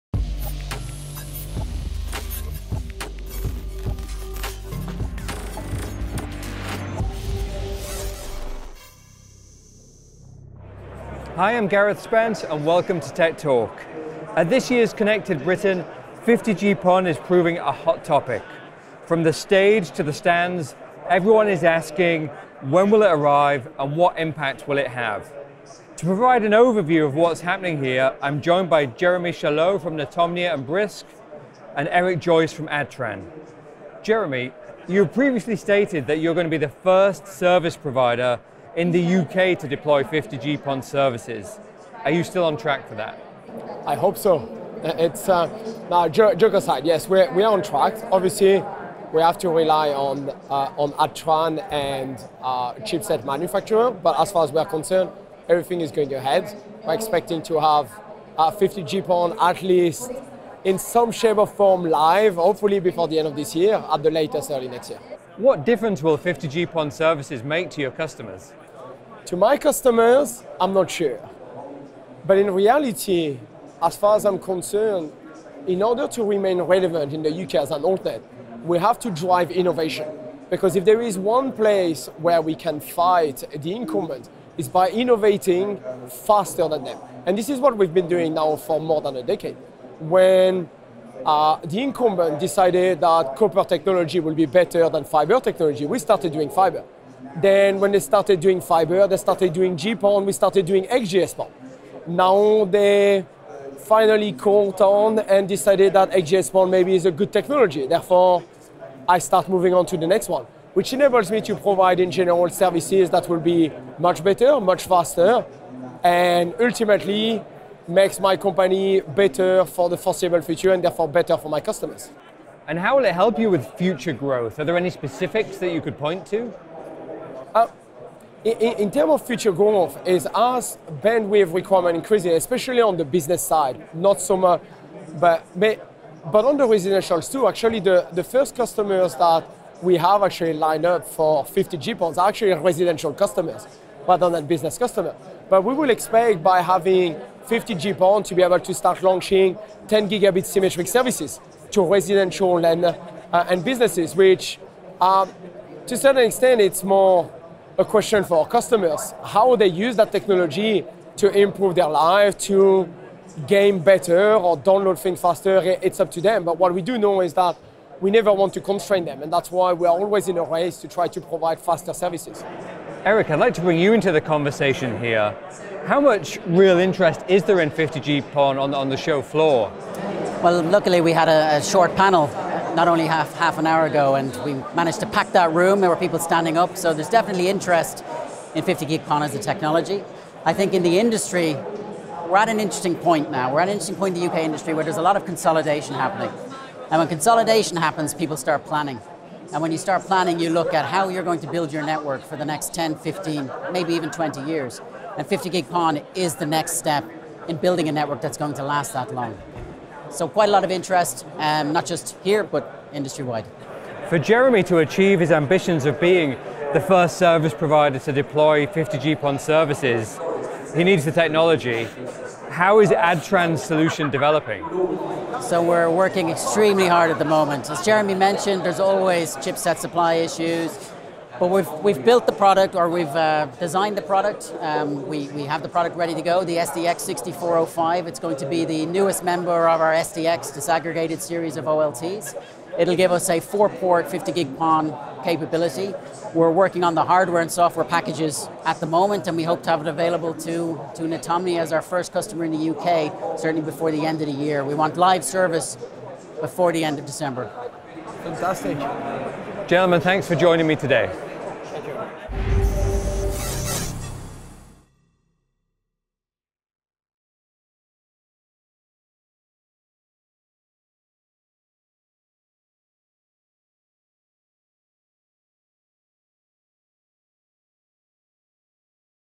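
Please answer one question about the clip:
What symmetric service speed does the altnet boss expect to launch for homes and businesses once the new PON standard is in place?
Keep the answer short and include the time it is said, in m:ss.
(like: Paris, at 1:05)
10 gigabit, at 2:29.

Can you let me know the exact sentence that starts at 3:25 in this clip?
And 50 gig PON is the next step in building a network that's going to last that long.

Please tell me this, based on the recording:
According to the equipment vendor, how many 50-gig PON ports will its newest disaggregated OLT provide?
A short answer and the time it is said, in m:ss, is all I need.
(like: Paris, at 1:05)
4, at 4:03.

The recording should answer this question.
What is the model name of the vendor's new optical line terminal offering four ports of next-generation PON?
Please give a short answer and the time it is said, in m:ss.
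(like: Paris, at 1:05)
SDX 6405, at 3:56.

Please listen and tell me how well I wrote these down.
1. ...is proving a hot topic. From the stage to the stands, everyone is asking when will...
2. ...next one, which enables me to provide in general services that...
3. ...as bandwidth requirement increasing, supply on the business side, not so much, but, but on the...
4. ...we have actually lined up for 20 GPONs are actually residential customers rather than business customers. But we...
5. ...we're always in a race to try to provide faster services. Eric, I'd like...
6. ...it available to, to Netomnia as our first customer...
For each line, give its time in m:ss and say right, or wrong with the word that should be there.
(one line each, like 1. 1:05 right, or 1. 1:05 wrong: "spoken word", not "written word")
1. 0:17 right
2. 1:50 right
3. 2:10 wrong: "especially", not "supply"
4. 2:19 wrong: "50", not "20"
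5. 2:49 right
6. 4:09 right.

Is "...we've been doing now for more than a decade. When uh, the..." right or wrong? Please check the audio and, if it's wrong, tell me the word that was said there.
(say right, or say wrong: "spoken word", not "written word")
right.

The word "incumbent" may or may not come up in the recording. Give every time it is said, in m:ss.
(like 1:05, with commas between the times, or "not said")
1:23, 1:31.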